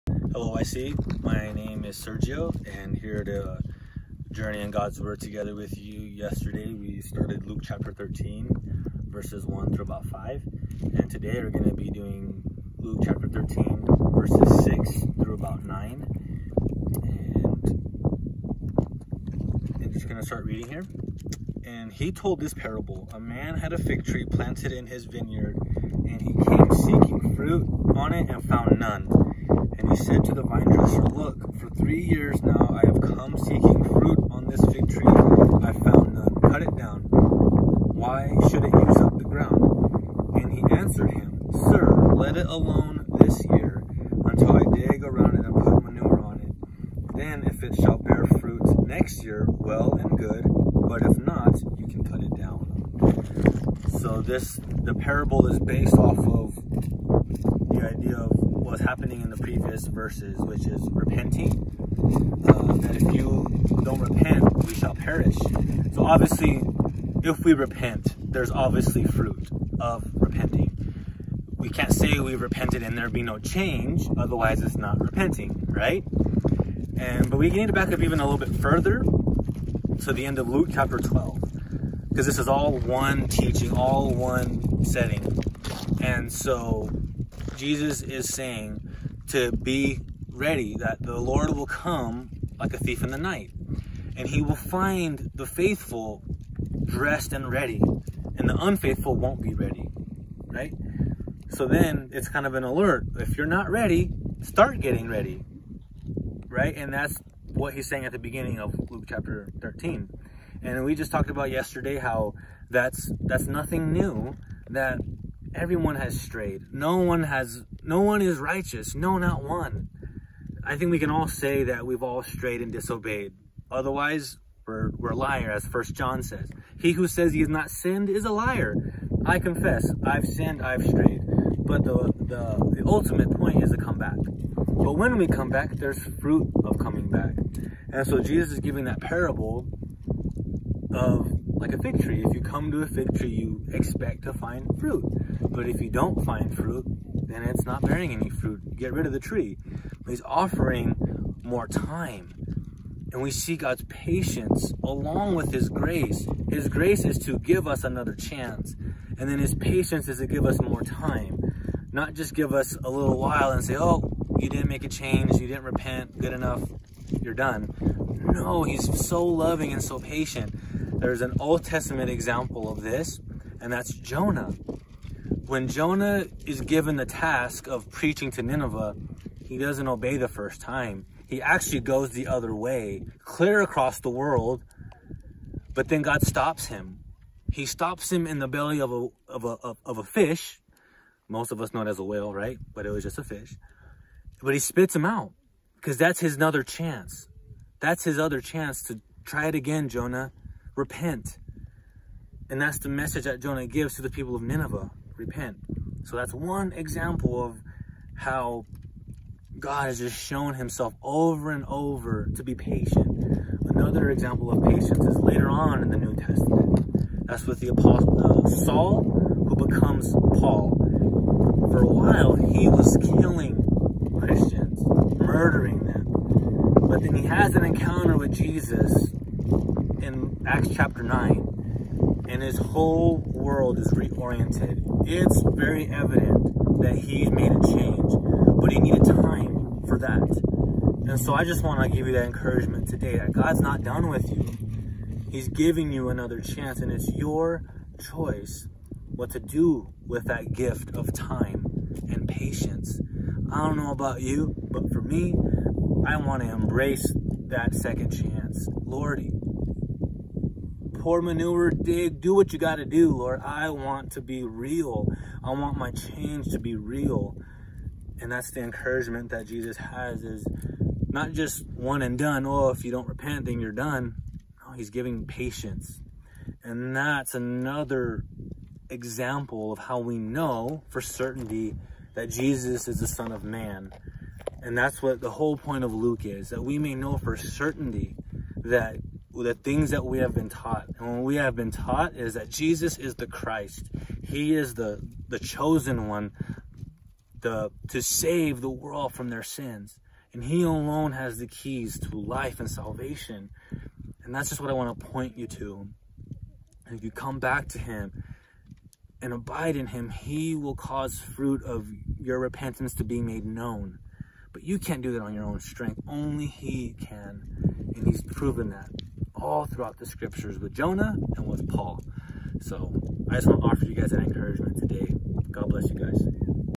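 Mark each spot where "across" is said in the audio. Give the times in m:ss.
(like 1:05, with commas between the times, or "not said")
3:03.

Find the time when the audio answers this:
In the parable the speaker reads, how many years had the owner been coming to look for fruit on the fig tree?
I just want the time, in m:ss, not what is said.
0:31.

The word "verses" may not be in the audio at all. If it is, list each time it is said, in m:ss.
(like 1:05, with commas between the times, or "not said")
0:09, 0:14, 0:59.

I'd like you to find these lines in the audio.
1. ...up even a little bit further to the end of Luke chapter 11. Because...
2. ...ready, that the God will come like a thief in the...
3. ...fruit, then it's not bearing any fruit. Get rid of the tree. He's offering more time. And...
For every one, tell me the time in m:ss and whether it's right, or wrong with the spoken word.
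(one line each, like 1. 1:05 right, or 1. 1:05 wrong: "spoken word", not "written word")
1. 1:17 wrong: "12", not "11"
2. 1:30 wrong: "Lord", not "God"
3. 2:26 right.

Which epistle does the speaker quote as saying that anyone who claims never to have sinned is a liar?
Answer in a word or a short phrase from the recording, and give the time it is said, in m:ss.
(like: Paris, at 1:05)
First John, at 2:05.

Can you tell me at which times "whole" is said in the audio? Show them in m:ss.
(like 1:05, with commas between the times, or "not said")
3:52, 4:45.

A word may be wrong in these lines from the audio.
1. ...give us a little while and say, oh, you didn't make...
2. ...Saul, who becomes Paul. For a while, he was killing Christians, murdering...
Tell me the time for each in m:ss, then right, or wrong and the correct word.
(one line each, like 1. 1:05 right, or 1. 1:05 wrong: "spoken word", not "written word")
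1. 2:42 right
2. 3:38 right.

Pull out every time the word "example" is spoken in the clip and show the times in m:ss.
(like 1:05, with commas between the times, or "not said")
2:52, 3:26, 3:34, 4:38.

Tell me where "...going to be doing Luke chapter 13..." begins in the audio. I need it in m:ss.
0:11.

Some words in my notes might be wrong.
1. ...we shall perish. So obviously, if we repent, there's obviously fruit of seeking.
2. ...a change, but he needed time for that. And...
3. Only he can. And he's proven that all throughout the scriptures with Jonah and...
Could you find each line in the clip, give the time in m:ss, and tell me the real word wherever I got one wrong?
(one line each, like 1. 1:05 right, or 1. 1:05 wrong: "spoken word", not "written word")
1. 1:04 wrong: "repenting", not "seeking"
2. 3:57 right
3. 5:16 right.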